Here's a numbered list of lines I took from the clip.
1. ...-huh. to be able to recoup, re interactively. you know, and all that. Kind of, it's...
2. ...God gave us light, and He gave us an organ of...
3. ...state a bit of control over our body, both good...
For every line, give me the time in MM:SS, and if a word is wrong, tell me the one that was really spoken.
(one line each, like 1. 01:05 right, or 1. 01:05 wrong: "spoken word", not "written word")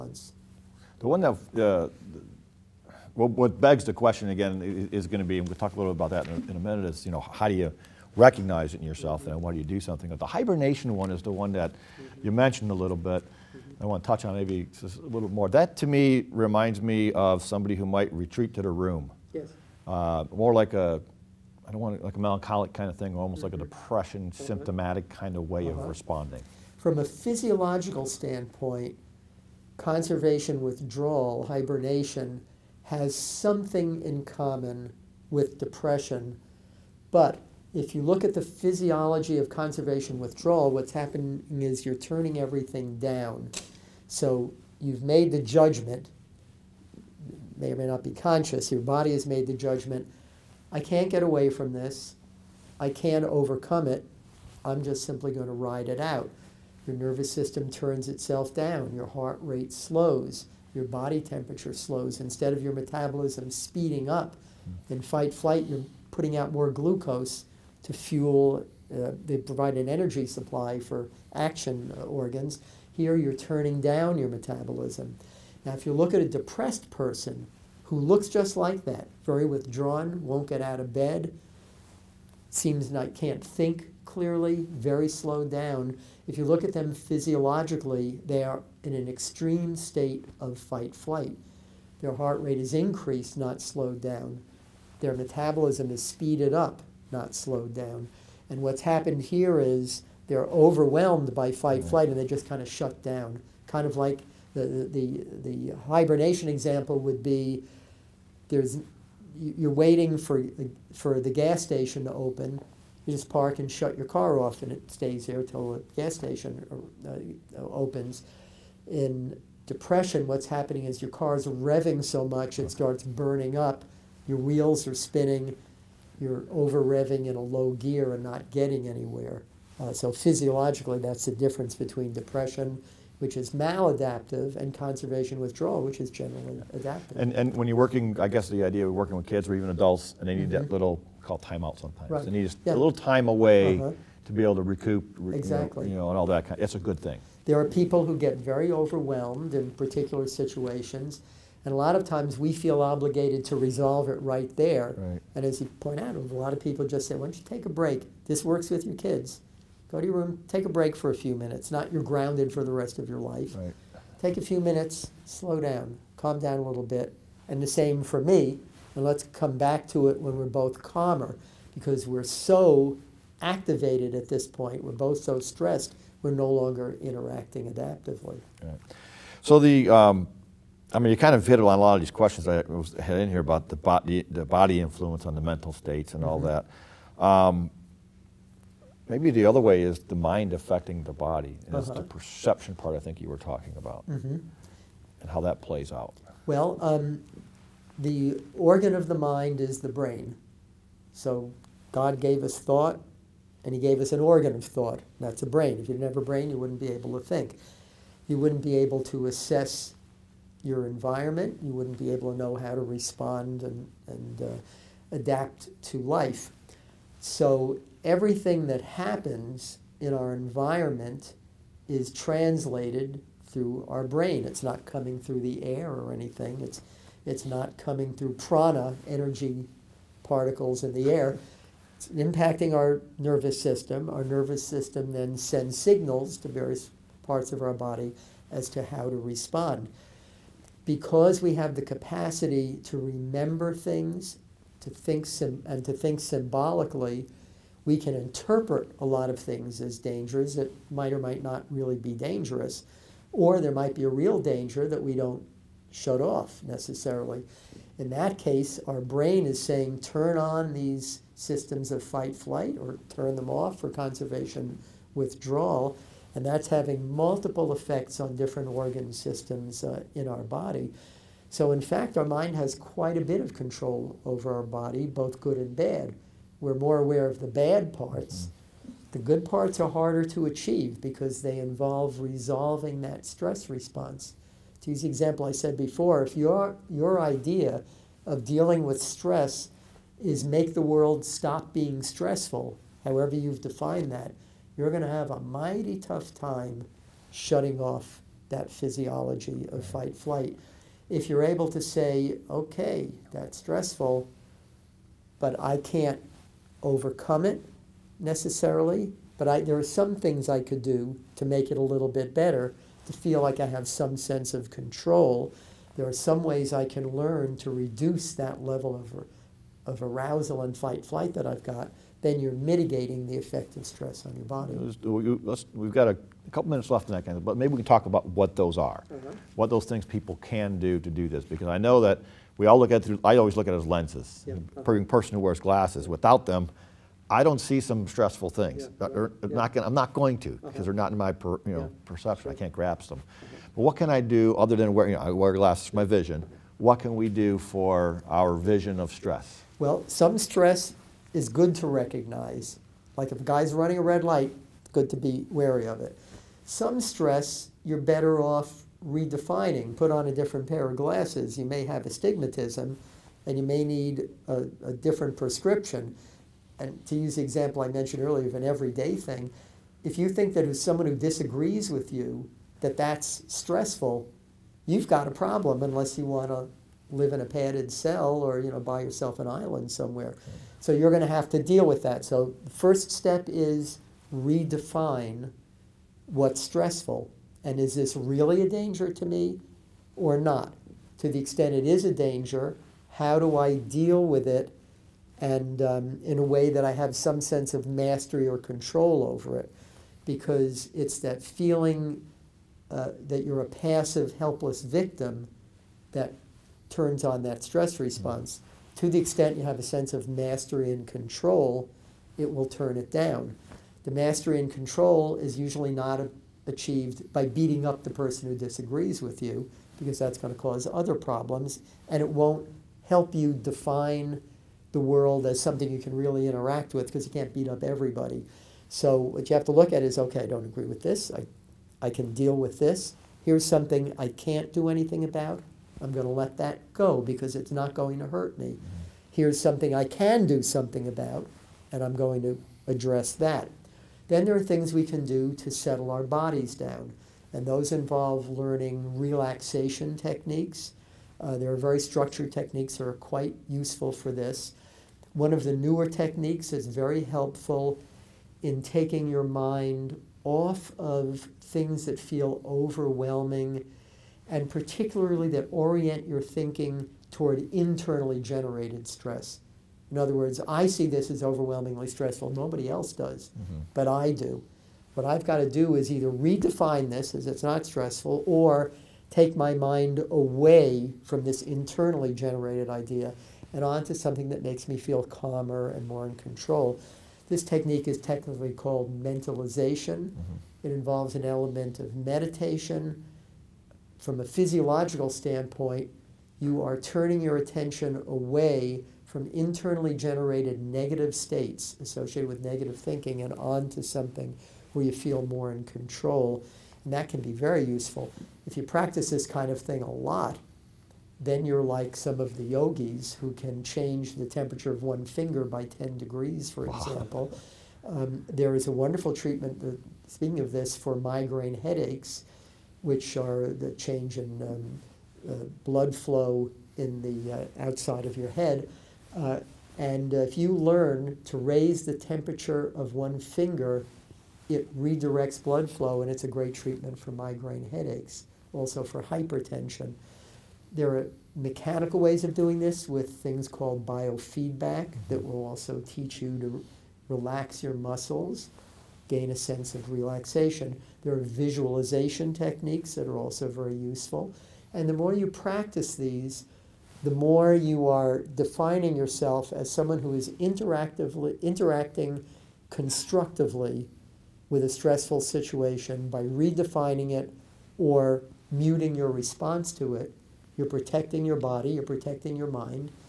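1. 02:23 wrong: "exactly", not "interactively"
2. 03:21 wrong: "thought", not "light"
3. 04:32 wrong: "quite", not "state".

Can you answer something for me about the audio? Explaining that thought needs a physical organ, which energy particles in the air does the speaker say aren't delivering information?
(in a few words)
Prana.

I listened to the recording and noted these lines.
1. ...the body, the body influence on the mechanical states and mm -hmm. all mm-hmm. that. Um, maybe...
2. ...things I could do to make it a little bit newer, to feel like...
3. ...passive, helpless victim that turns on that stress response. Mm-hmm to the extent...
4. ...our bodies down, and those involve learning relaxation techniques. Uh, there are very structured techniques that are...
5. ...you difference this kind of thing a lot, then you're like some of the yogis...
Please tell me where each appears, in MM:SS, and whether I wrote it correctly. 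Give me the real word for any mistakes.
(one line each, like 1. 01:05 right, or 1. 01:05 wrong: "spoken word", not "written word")
1. 03:03 wrong: "mental", not "mechanical"
2. 05:10 wrong: "better", not "newer"
3. 06:43 right
4. 07:26 right
5. 08:28 wrong: "practice", not "difference".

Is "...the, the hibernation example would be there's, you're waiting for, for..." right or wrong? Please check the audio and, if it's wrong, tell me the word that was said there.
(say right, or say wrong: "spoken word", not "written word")
right.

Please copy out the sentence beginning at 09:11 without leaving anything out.
There are visualization techniques that are also very useful.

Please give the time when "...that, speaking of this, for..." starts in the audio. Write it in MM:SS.
08:39.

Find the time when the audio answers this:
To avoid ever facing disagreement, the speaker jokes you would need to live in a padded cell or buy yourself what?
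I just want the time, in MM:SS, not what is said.
06:19.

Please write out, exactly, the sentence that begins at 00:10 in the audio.
But the hibernation one is the one that you mentioned a little bit.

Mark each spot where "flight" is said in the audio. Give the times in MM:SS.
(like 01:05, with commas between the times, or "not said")
01:05, 01:30, 01:41, 04:22, 05:00, 05:21.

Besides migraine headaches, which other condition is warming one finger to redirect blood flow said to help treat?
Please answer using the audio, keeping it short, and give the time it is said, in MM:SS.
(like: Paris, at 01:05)
Hypertension, at 08:59.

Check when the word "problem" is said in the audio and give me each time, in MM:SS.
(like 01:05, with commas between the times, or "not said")
06:15, 07:01.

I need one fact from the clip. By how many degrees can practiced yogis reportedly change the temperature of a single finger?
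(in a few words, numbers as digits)
10.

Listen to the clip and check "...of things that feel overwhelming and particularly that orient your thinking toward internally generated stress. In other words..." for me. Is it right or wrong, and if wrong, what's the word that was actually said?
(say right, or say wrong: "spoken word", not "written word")
right.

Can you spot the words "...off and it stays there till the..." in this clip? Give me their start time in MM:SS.
01:54.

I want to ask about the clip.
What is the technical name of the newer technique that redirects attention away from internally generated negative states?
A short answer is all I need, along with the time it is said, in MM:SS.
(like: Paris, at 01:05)
Mentalization, at 08:09.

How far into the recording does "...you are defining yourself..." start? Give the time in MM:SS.
09:17.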